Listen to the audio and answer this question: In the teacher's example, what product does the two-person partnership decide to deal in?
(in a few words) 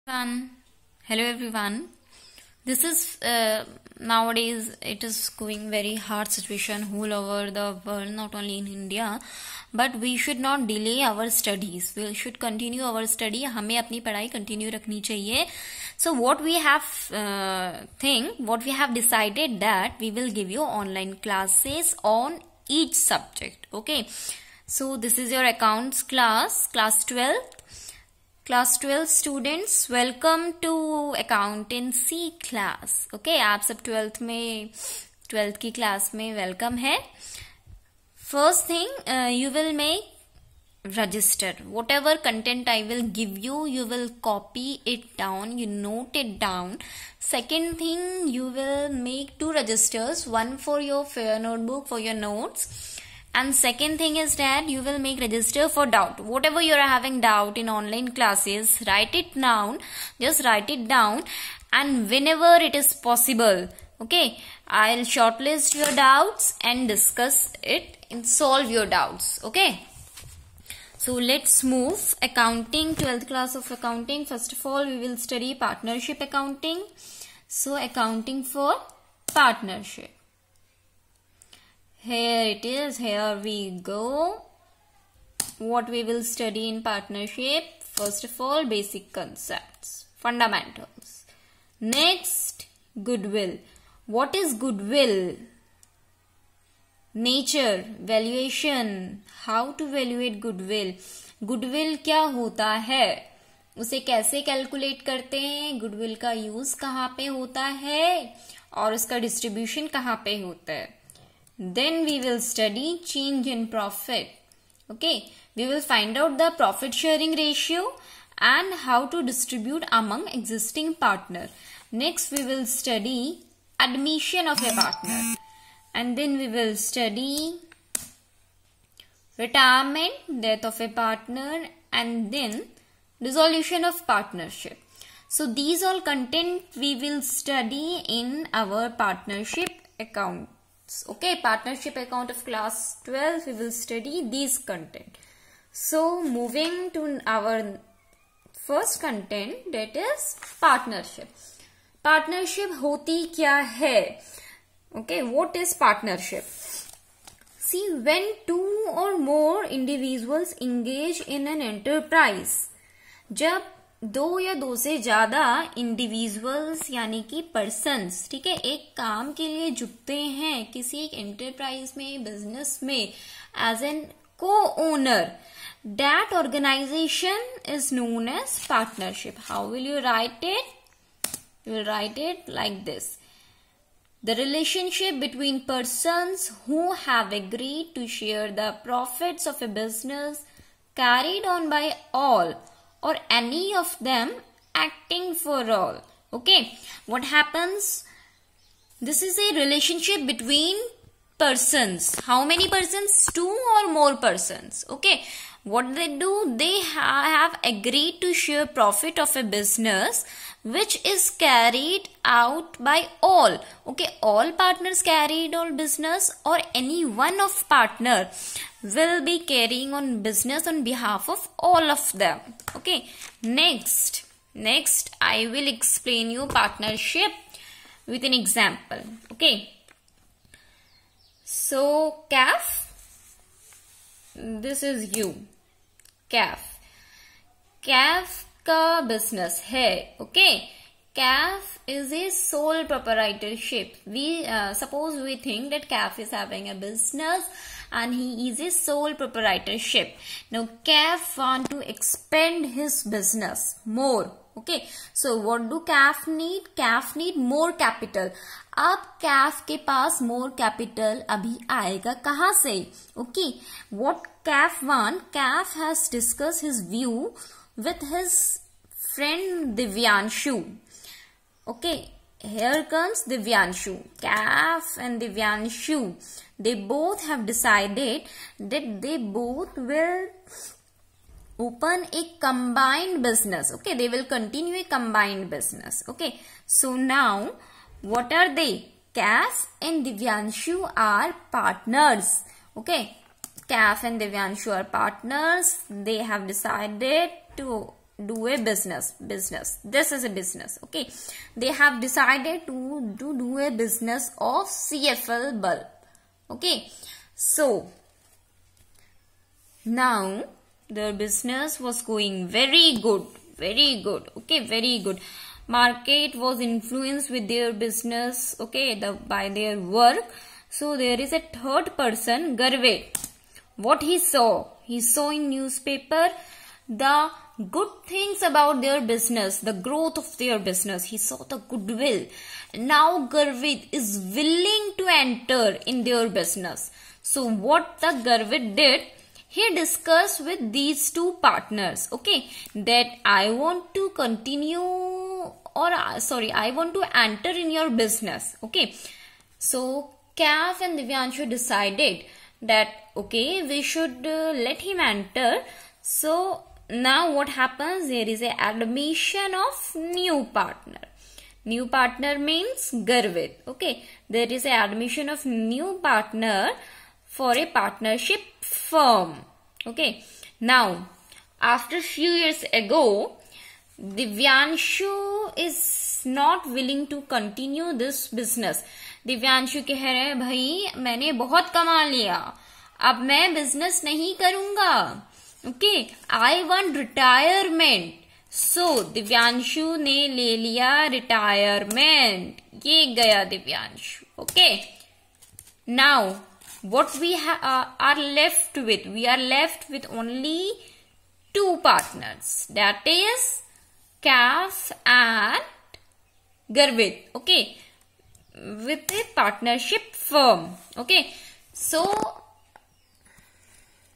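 CFL bulb.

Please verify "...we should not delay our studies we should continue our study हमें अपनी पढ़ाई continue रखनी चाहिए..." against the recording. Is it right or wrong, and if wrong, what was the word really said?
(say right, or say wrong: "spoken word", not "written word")
right.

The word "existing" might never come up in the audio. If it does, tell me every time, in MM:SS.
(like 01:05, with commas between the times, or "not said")
02:00.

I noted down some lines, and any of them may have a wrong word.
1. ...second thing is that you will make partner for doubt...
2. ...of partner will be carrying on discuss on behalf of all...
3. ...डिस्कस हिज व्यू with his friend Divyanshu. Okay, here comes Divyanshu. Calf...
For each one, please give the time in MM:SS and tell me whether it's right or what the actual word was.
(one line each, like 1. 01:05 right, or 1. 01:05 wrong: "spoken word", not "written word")
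1. 00:53 wrong: "register", not "partner"
2. 03:37 wrong: "business", not "discuss"
3. 04:26 right.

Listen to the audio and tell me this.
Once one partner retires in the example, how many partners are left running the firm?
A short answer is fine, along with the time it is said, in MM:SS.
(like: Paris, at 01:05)
2, at 06:41.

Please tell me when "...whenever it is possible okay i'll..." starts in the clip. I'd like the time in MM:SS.
01:02.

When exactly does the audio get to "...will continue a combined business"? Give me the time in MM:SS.
04:44.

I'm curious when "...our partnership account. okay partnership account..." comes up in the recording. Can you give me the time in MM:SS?
02:18.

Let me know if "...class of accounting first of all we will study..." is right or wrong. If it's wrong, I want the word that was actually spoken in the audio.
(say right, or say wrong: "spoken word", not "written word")
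right.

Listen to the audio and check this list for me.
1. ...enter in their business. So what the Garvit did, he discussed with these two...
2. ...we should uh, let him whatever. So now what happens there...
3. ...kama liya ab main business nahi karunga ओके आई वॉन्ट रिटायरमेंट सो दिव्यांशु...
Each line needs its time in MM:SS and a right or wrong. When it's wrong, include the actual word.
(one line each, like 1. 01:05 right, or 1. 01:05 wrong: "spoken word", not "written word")
1. 05:35 right
2. 05:53 wrong: "enter", not "whatever"
3. 06:21 right.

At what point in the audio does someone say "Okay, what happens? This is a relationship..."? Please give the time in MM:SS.
03:16.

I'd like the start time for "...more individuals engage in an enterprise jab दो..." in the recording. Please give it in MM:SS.
02:39.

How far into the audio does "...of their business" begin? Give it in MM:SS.
05:30.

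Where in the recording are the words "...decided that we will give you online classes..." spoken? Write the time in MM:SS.
00:19.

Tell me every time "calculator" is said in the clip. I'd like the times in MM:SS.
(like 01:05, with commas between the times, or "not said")
not said.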